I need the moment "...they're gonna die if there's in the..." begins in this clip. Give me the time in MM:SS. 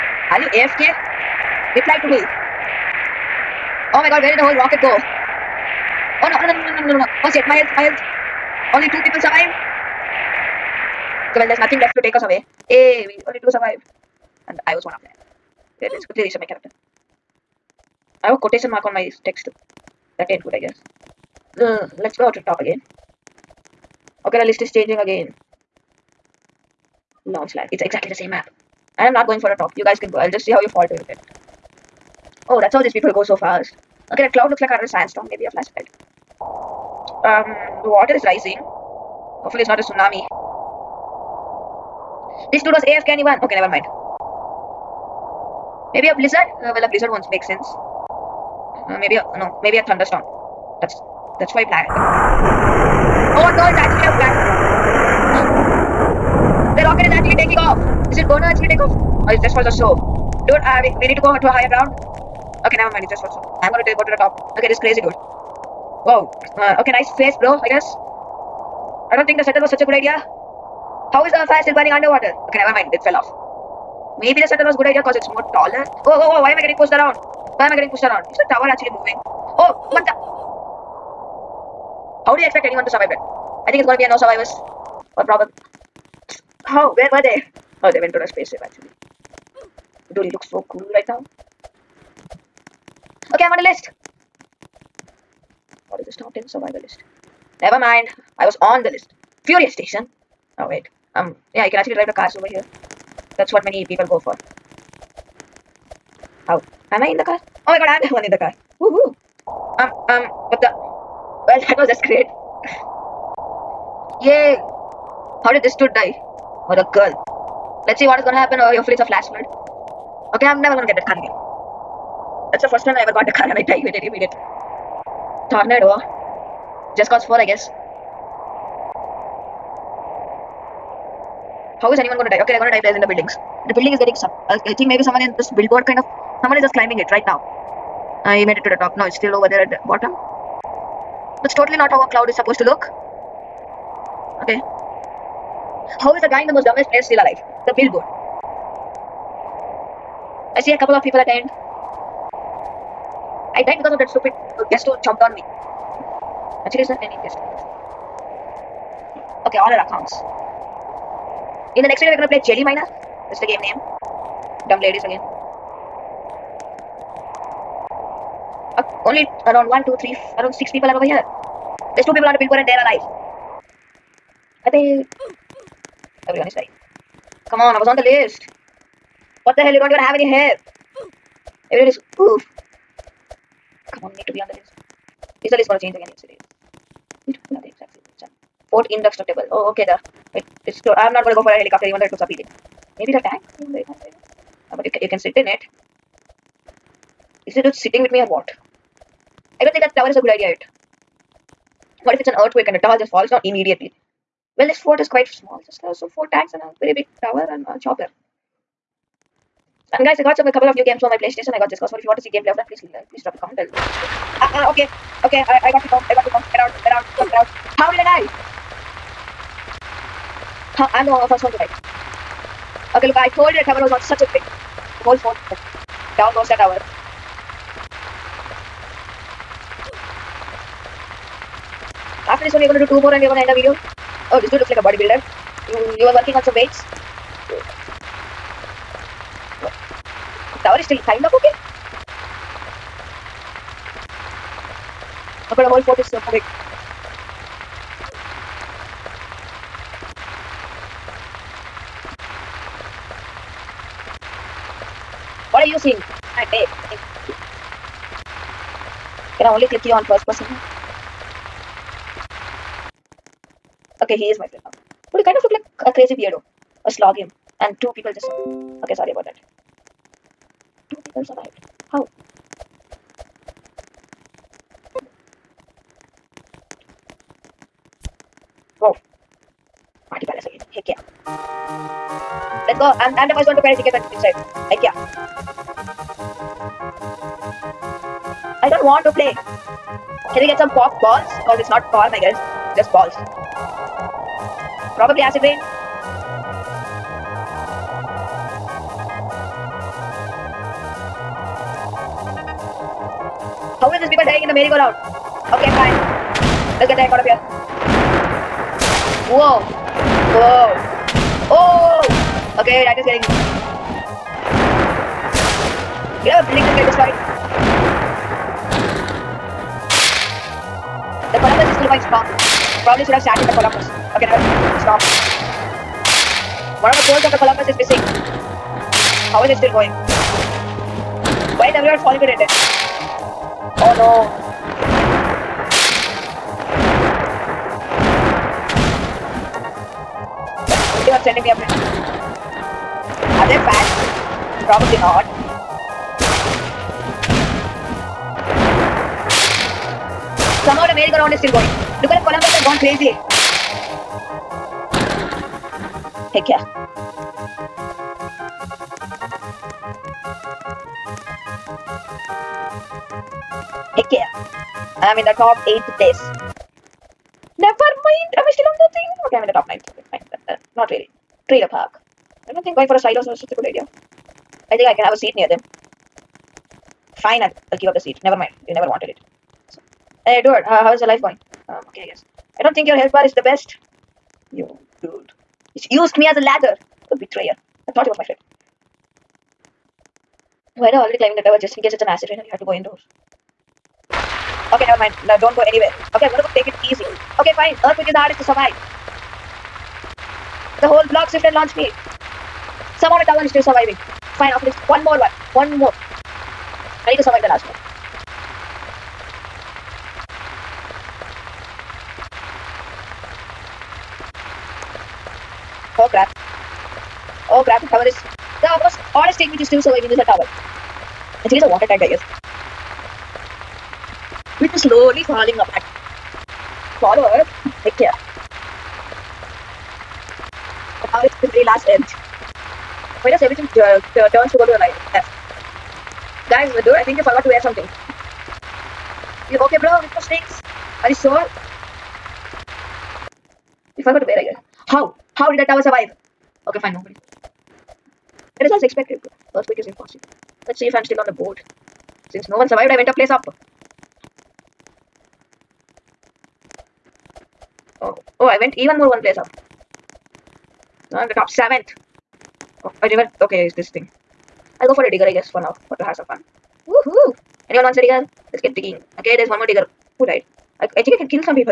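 02:12.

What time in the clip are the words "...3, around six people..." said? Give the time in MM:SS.
02:50.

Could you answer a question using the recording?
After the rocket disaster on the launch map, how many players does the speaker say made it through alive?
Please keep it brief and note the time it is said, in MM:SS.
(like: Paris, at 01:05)
2, at 00:08.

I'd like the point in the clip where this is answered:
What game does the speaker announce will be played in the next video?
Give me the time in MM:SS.
02:42.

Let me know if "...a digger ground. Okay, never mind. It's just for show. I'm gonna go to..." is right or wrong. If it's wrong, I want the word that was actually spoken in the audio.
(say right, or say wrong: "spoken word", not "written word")
wrong: "higher", not "digger".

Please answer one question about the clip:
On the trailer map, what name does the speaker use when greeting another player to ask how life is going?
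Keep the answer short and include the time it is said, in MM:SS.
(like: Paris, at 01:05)
Edward, at 06:20.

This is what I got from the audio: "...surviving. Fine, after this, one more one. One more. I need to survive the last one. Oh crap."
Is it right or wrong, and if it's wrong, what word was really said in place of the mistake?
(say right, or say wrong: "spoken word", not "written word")
right.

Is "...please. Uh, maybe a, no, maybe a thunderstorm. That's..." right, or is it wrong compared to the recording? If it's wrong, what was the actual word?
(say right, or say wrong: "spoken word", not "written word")
wrong: "sense", not "please".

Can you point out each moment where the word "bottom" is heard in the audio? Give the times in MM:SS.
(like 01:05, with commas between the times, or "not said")
02:19.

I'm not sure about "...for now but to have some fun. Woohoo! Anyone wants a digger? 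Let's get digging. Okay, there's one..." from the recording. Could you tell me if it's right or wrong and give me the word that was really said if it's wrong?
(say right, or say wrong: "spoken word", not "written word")
right.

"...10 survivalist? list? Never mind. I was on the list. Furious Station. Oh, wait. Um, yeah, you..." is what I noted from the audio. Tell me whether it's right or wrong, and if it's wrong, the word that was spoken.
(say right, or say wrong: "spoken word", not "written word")
right.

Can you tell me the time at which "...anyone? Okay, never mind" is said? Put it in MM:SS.
00:43.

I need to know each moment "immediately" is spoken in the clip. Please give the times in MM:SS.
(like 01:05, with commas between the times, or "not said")
02:04, 03:23.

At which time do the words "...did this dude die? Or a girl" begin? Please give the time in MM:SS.
01:55.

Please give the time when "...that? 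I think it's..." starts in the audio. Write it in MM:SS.
01:23.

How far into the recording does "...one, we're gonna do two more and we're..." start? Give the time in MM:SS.
03:52.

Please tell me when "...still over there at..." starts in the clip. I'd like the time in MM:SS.
02:19.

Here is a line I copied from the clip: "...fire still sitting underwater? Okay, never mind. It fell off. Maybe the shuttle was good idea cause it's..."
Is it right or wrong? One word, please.
wrong.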